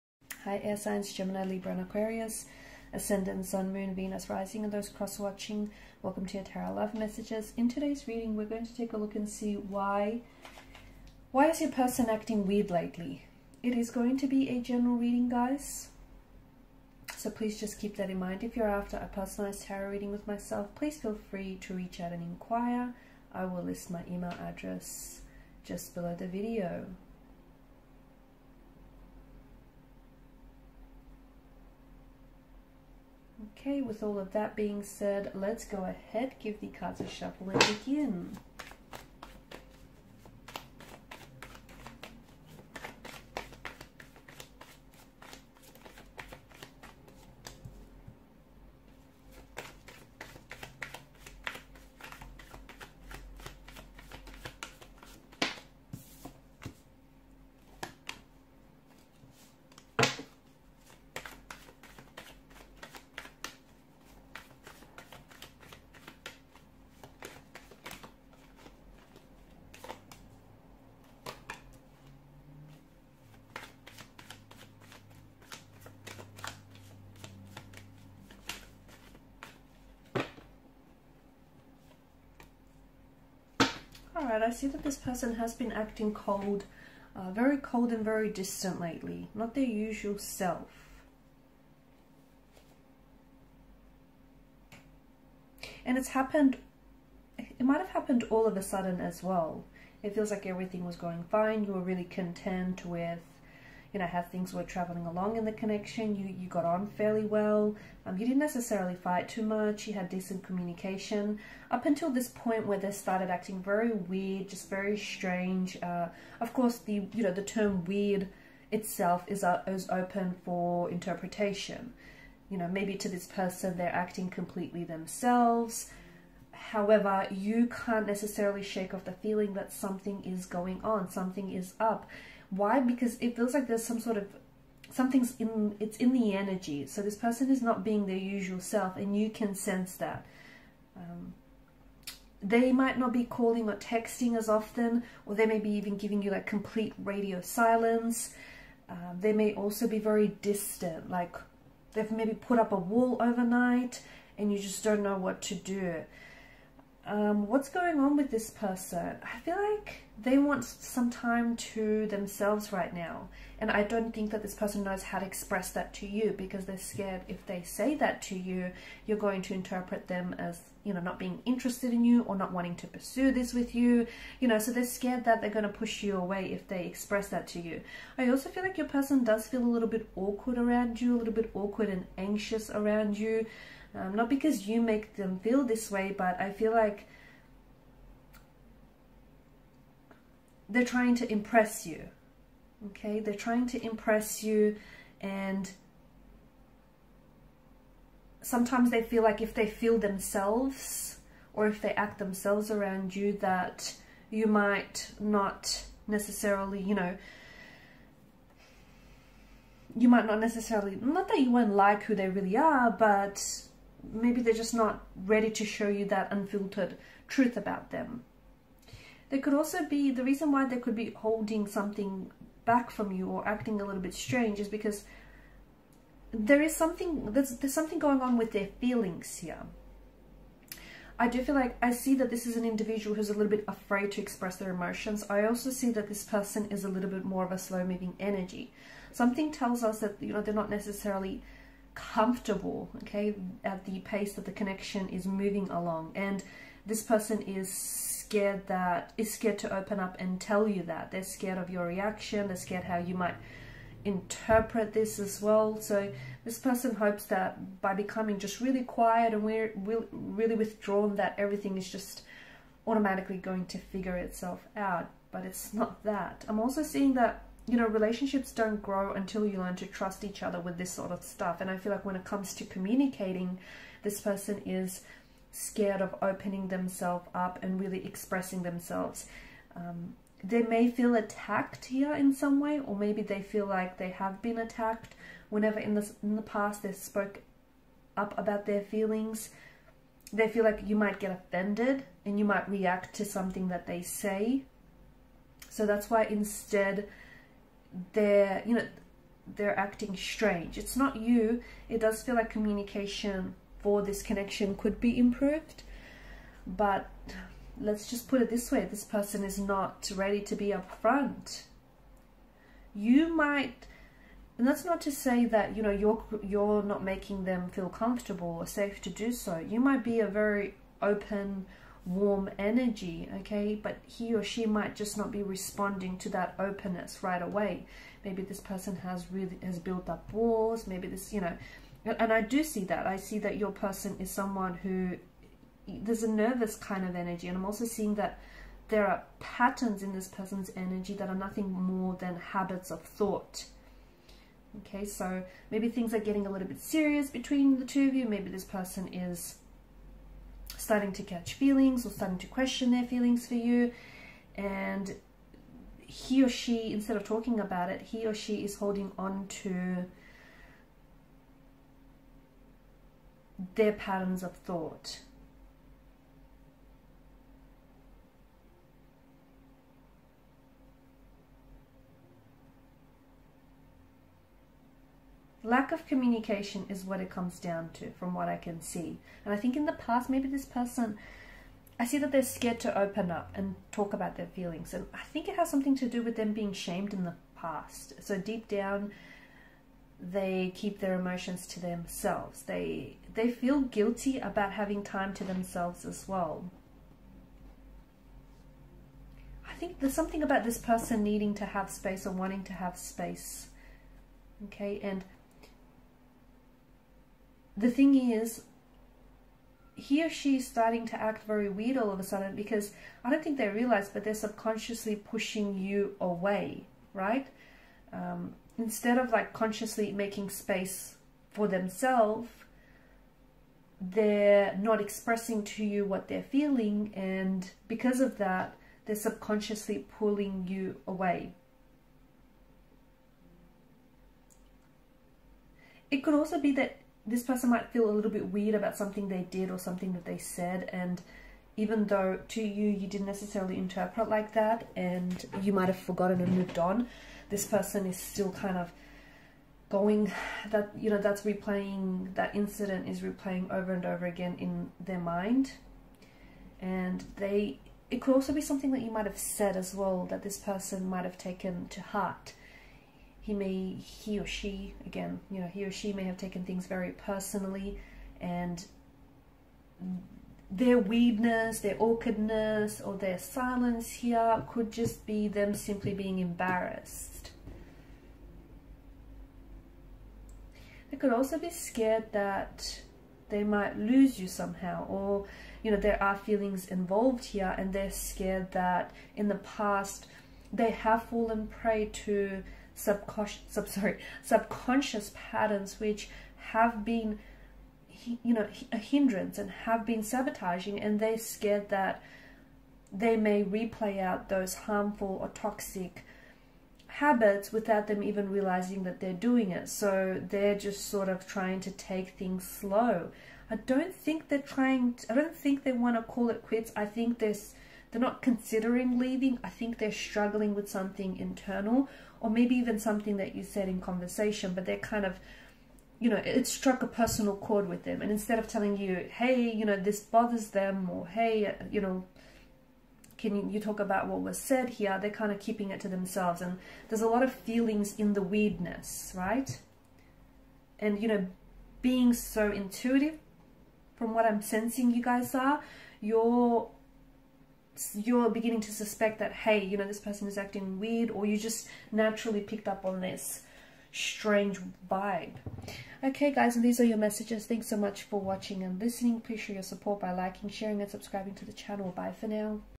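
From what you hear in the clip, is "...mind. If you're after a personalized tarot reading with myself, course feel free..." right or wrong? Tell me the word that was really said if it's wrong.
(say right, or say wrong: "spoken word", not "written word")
wrong: "please", not "course".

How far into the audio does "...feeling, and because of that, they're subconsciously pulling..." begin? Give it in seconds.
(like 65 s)
426 s.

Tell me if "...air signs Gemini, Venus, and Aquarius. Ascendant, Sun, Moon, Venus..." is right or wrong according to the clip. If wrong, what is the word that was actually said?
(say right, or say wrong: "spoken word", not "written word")
wrong: "Libra", not "Venus".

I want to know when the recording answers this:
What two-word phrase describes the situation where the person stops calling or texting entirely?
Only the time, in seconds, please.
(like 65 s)
147 s.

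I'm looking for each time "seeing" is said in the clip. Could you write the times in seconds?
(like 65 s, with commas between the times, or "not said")
266 s, 337 s.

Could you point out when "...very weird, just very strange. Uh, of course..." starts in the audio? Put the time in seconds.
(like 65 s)
113 s.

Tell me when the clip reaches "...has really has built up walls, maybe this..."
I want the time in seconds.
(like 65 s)
328 s.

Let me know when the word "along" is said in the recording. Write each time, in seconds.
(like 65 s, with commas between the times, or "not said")
105 s, 245 s.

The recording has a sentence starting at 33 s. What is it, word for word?
Okay, with all of that being said, let's go ahead, give the cards a shuffle and begin.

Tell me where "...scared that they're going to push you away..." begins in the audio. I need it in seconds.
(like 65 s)
174 s.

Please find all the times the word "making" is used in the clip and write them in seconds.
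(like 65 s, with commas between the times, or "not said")
317 s, 420 s.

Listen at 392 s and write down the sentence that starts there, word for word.
They, they feel guilty about having time to themselves as well.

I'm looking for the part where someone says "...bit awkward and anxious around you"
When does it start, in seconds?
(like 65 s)
181 s.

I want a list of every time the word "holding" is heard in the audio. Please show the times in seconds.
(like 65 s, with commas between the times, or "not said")
221 s, 358 s.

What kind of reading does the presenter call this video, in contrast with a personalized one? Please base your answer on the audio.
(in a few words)
General reading.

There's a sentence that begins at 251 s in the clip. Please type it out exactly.
They're scared of your reaction, they're scared how you might interpret this as well.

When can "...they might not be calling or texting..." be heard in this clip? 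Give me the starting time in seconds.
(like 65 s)
142 s.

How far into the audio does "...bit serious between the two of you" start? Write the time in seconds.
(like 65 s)
346 s.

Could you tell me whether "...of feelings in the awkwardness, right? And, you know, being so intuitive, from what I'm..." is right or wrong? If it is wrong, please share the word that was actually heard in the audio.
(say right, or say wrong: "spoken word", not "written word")
wrong: "weirdness", not "awkwardness".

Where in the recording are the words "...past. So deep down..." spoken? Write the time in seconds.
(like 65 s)
387 s.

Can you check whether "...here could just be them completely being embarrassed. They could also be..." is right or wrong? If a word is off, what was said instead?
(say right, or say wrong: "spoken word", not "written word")
wrong: "simply", not "completely".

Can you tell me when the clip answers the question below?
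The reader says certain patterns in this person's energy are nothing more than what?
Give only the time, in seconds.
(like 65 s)
342 s.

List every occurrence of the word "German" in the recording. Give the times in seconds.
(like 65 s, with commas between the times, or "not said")
not said.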